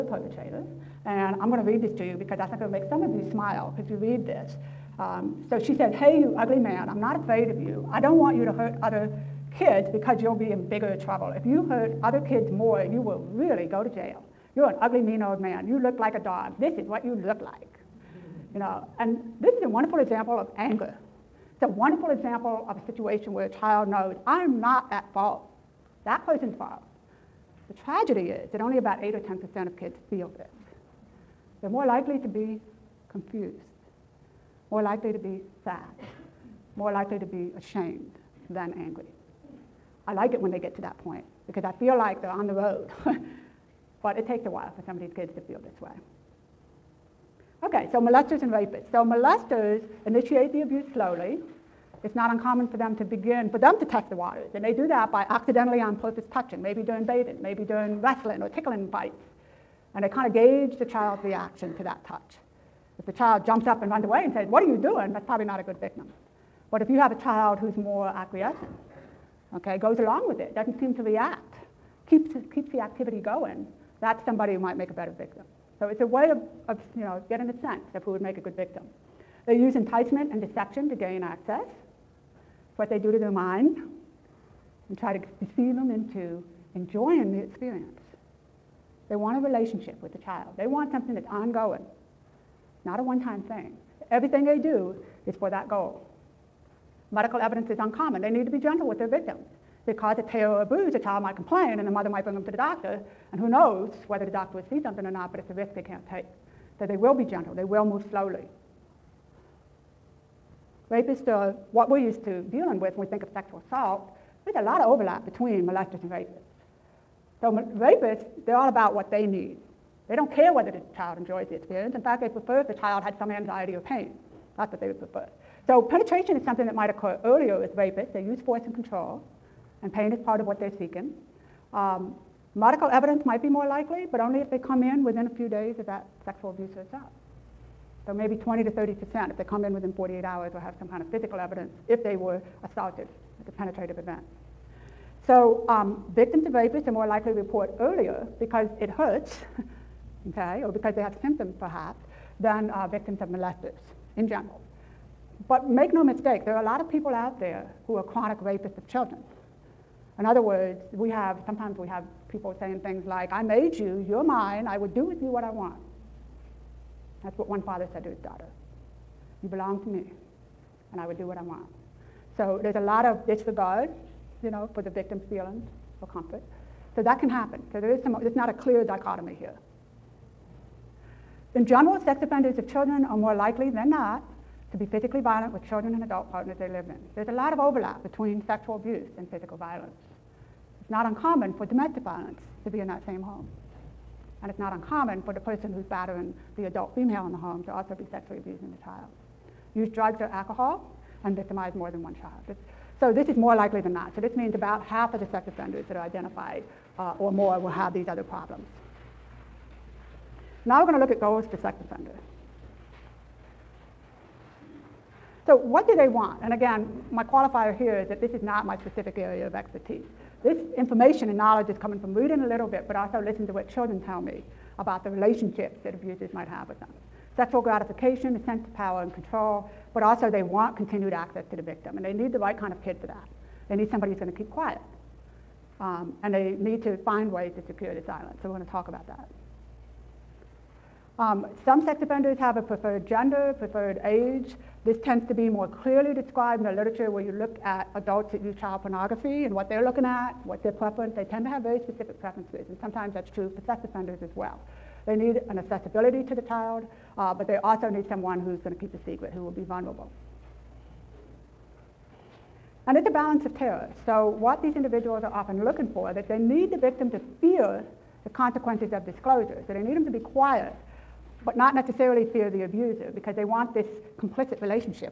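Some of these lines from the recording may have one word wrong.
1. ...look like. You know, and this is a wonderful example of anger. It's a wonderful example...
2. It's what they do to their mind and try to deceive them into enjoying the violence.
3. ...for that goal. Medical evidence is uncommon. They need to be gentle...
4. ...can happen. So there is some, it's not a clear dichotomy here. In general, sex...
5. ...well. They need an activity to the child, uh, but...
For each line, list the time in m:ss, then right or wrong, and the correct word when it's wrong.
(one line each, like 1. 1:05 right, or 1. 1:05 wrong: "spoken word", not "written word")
1. 0:17 right
2. 1:22 wrong: "experience", not "violence"
3. 1:35 right
4. 2:57 right
5. 4:14 wrong: "accessibility", not "activity".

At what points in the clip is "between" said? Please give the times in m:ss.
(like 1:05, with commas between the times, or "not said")
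1:55, 3:08.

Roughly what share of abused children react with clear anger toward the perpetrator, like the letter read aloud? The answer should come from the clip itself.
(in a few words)
8 or 10%.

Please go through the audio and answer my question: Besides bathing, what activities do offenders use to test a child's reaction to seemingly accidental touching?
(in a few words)
wrestling or tickling fights.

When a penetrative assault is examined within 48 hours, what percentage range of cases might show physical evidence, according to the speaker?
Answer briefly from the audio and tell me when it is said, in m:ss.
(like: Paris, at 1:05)
20 to 30 percent, at 2:18.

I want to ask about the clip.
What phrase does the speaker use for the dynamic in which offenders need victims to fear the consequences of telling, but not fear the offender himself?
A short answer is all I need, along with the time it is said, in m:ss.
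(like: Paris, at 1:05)
balance of terror, at 4:23.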